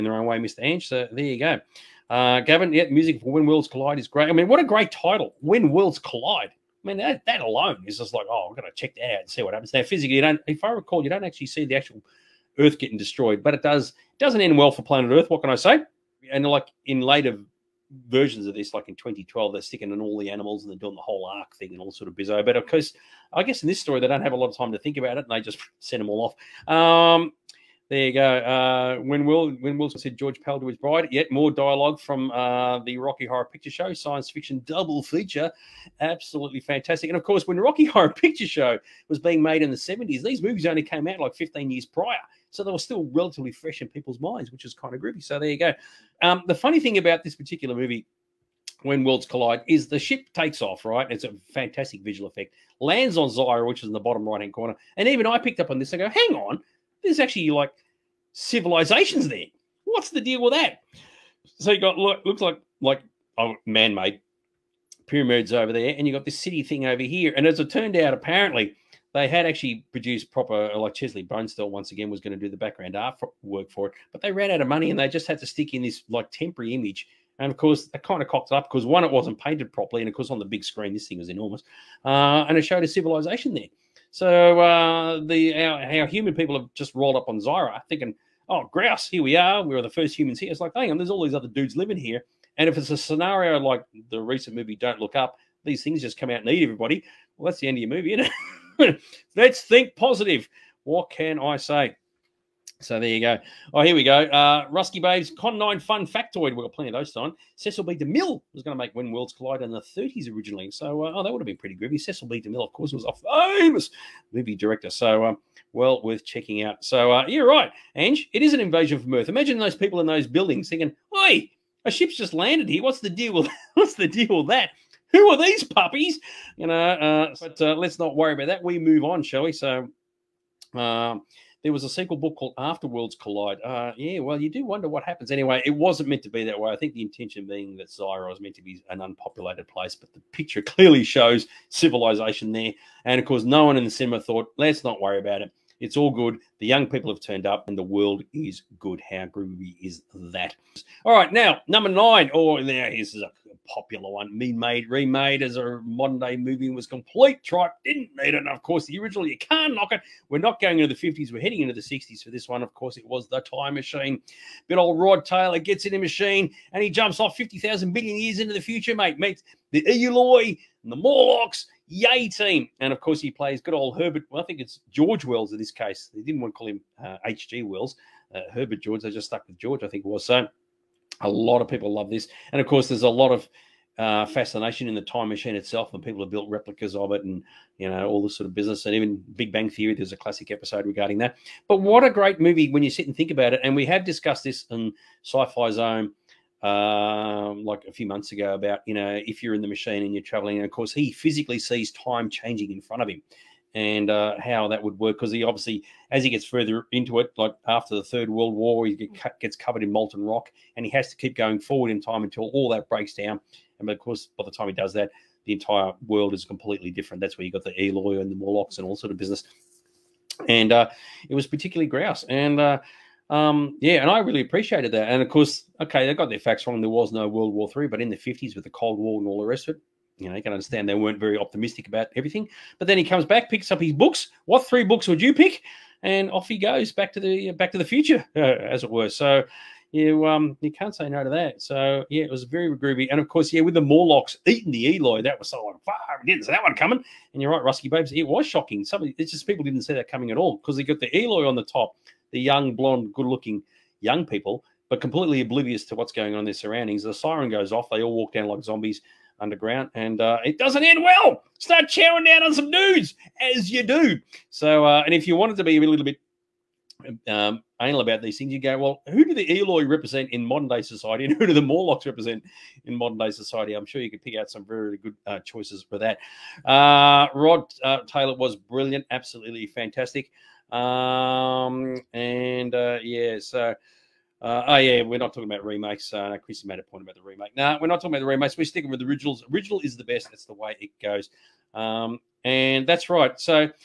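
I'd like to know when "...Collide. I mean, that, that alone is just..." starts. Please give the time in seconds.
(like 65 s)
5 s.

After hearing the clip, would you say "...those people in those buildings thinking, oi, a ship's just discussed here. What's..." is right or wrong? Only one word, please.
wrong.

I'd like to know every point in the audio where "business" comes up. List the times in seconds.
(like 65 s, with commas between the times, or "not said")
188 s, 219 s.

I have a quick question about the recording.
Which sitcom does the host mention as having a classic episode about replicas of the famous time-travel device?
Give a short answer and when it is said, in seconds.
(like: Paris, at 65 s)
Big Bang Theory, at 189 s.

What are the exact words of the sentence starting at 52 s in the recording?
Lands on Zyra, which is in the bottom right hand corner.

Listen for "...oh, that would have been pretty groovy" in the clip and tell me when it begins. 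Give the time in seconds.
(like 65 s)
111 s.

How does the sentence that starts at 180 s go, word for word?
So a lot of people love this.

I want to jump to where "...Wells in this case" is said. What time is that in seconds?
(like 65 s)
175 s.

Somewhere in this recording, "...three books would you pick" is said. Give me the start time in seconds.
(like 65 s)
234 s.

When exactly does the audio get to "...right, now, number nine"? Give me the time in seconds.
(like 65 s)
151 s.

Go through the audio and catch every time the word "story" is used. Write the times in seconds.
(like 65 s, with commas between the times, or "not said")
23 s.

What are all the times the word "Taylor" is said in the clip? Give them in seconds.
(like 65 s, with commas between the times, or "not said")
165 s, 278 s.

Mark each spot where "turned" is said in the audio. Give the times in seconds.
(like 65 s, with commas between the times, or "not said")
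67 s, 147 s.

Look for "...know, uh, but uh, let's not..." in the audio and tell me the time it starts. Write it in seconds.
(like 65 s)
126 s.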